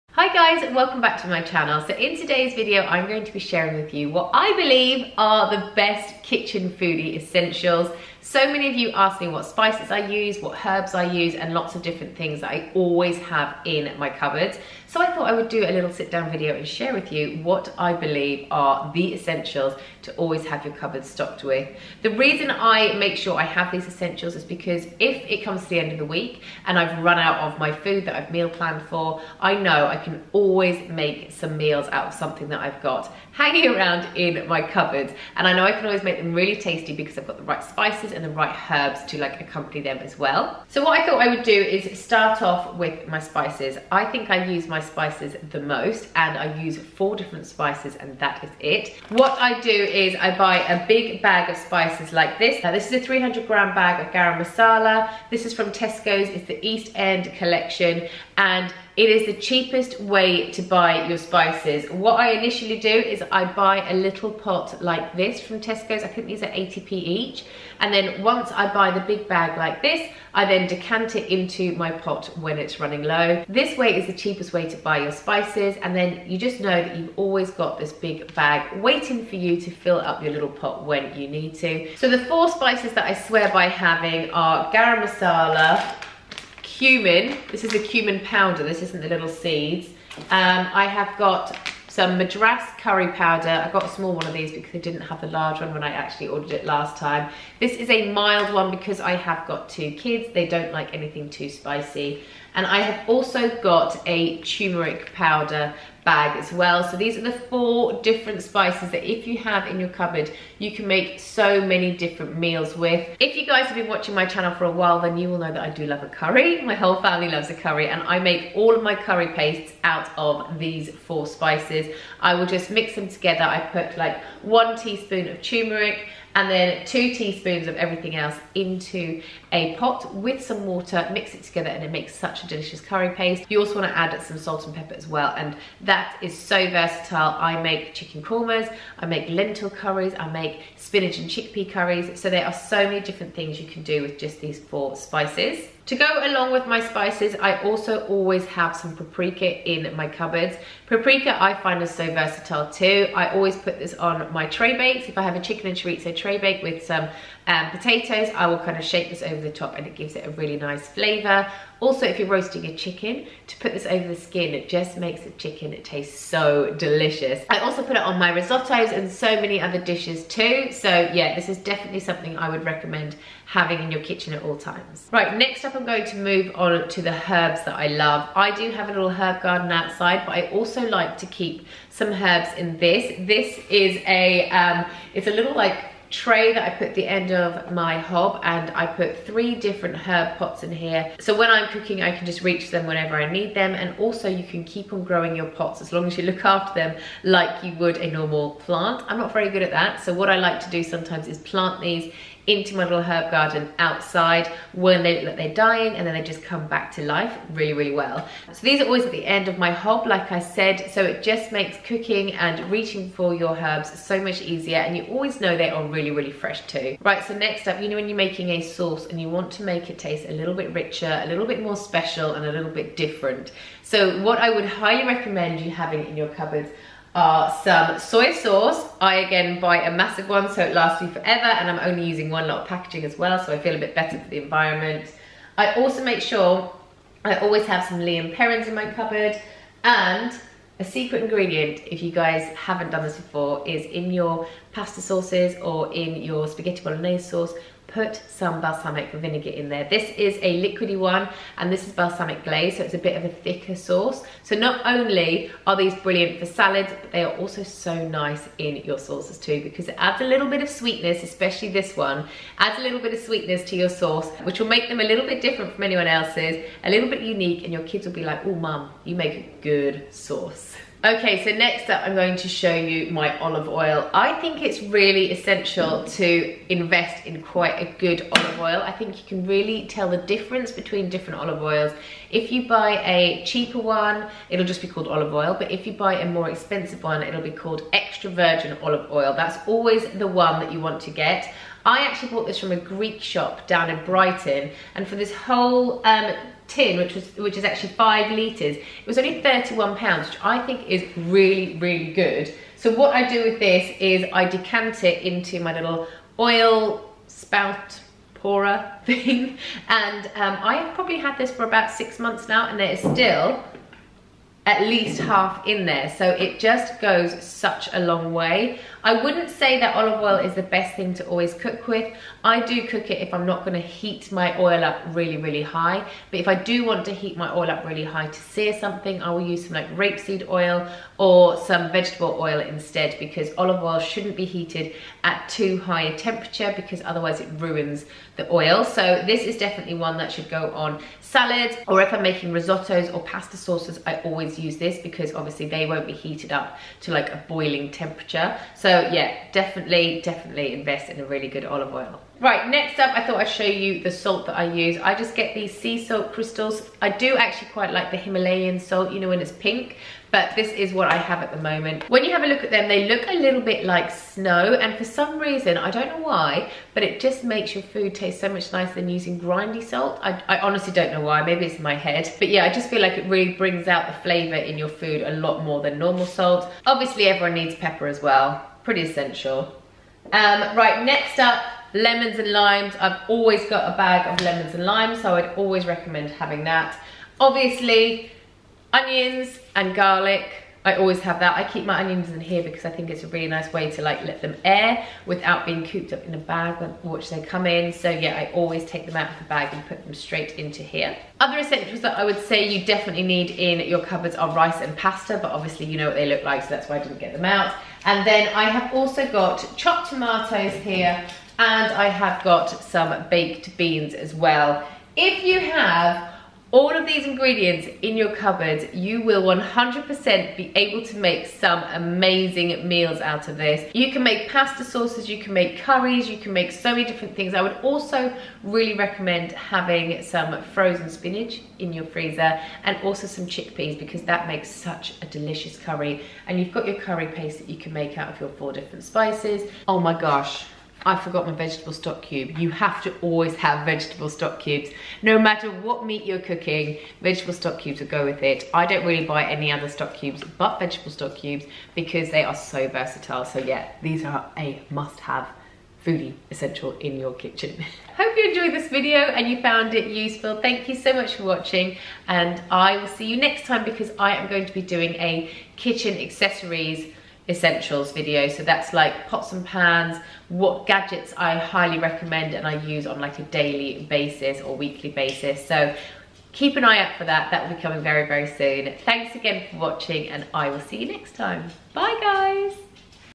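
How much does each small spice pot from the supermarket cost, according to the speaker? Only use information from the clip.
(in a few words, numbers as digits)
80p.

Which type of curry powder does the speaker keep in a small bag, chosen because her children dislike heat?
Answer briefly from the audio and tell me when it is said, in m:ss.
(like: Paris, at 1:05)
Madras, at 1:32.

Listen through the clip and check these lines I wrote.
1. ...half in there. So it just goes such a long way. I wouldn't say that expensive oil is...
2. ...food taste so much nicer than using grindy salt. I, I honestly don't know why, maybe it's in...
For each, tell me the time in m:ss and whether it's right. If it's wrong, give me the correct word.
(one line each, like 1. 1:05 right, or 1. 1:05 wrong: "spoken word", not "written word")
1. 5:15 wrong: "olive", not "expensive"
2. 6:07 right.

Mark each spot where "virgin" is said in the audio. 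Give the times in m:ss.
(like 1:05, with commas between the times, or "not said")
4:48.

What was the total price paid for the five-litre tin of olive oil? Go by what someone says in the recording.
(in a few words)
£31.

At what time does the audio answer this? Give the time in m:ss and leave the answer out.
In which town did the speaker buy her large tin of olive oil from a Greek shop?
4:54.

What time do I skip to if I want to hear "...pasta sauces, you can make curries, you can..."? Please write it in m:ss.
7:04.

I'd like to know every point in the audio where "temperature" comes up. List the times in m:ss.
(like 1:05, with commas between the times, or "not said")
5:36, 5:47.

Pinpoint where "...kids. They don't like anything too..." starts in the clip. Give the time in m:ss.
1:39.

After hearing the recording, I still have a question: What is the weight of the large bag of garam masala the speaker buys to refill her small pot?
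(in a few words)
300 grams.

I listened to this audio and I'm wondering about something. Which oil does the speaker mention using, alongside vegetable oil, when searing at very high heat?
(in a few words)
Rapeseed oil.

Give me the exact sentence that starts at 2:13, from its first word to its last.
You also want to add some salt and pepper as well and that is so versatile.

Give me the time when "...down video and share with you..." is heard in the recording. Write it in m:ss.
0:16.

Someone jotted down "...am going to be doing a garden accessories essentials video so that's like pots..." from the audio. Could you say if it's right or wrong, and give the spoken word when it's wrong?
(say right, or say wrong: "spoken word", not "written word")
wrong: "kitchen", not "garden".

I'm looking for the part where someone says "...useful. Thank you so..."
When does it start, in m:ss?
7:40.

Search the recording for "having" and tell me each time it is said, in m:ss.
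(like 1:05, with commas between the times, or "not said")
1:23, 2:53, 3:45, 6:26, 7:09.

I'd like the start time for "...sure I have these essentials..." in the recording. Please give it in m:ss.
0:23.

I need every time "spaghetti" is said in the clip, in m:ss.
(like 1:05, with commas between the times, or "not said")
4:06.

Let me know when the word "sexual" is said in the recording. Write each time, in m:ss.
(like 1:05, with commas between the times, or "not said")
not said.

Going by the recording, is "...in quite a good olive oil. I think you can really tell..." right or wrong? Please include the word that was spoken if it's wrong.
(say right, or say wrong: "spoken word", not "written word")
right.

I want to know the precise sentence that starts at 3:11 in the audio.
So when I'm cooking, I can just reach them whenever I need them.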